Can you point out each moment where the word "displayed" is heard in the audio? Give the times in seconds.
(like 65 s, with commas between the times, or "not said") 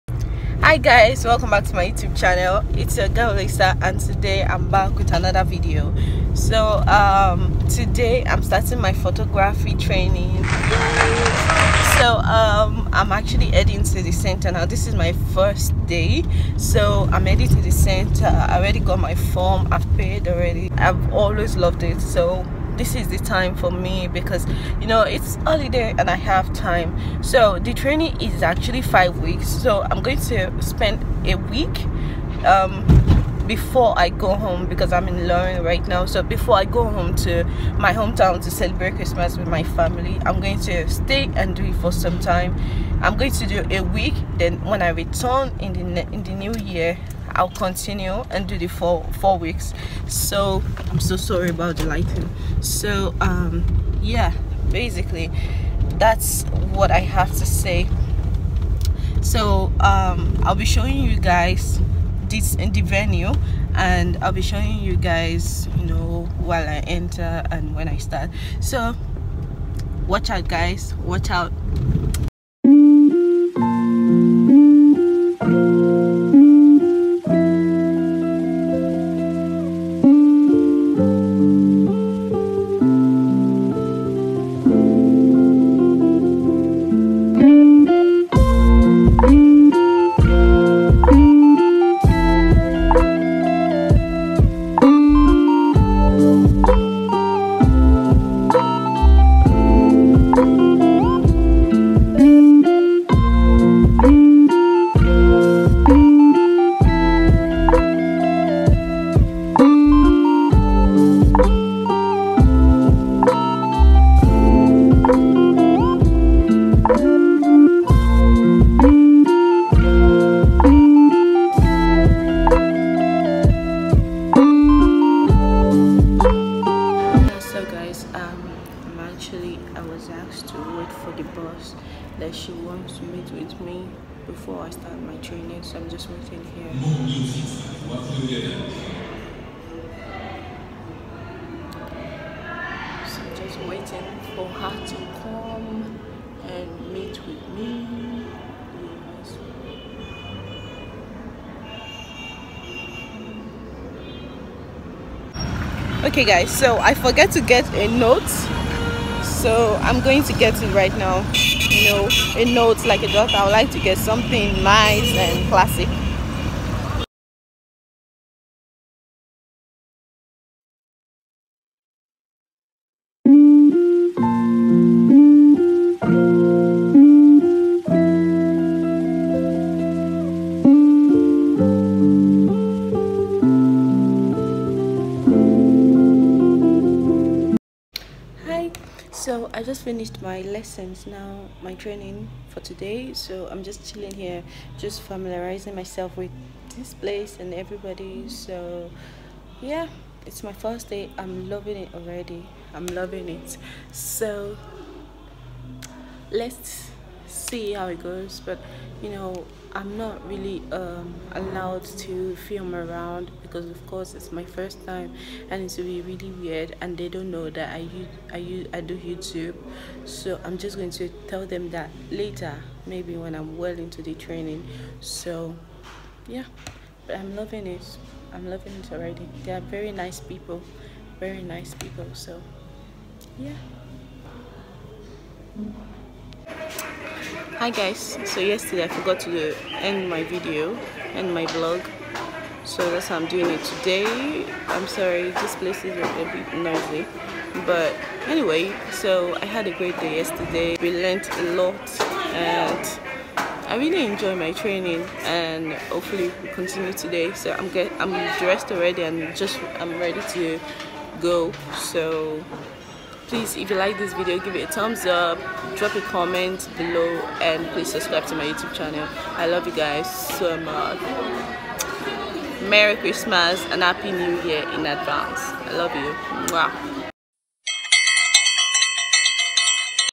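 not said.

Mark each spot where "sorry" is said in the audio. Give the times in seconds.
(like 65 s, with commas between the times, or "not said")
51 s, 244 s.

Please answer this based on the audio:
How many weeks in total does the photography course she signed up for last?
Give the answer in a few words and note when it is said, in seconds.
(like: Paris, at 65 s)
5, at 28 s.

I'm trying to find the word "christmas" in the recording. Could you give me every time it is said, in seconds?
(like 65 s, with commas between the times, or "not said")
38 s, 272 s.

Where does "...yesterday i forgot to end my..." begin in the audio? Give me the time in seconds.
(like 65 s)
238 s.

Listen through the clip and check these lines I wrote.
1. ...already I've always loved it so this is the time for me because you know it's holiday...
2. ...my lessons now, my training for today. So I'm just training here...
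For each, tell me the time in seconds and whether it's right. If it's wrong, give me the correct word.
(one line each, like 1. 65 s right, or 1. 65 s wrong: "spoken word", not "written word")
1. 20 s right
2. 190 s wrong: "chilling", not "training".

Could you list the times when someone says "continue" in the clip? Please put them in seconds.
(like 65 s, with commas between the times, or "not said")
47 s, 256 s.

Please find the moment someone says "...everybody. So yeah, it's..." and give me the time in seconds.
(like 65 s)
197 s.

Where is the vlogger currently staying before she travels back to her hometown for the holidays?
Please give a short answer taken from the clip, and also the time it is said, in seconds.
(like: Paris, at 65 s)
Lorraine, at 35 s.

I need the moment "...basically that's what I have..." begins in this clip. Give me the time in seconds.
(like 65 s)
54 s.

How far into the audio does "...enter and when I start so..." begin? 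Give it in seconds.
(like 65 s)
66 s.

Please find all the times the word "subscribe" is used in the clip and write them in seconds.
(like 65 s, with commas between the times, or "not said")
267 s.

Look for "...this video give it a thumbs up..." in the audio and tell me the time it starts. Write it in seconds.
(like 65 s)
263 s.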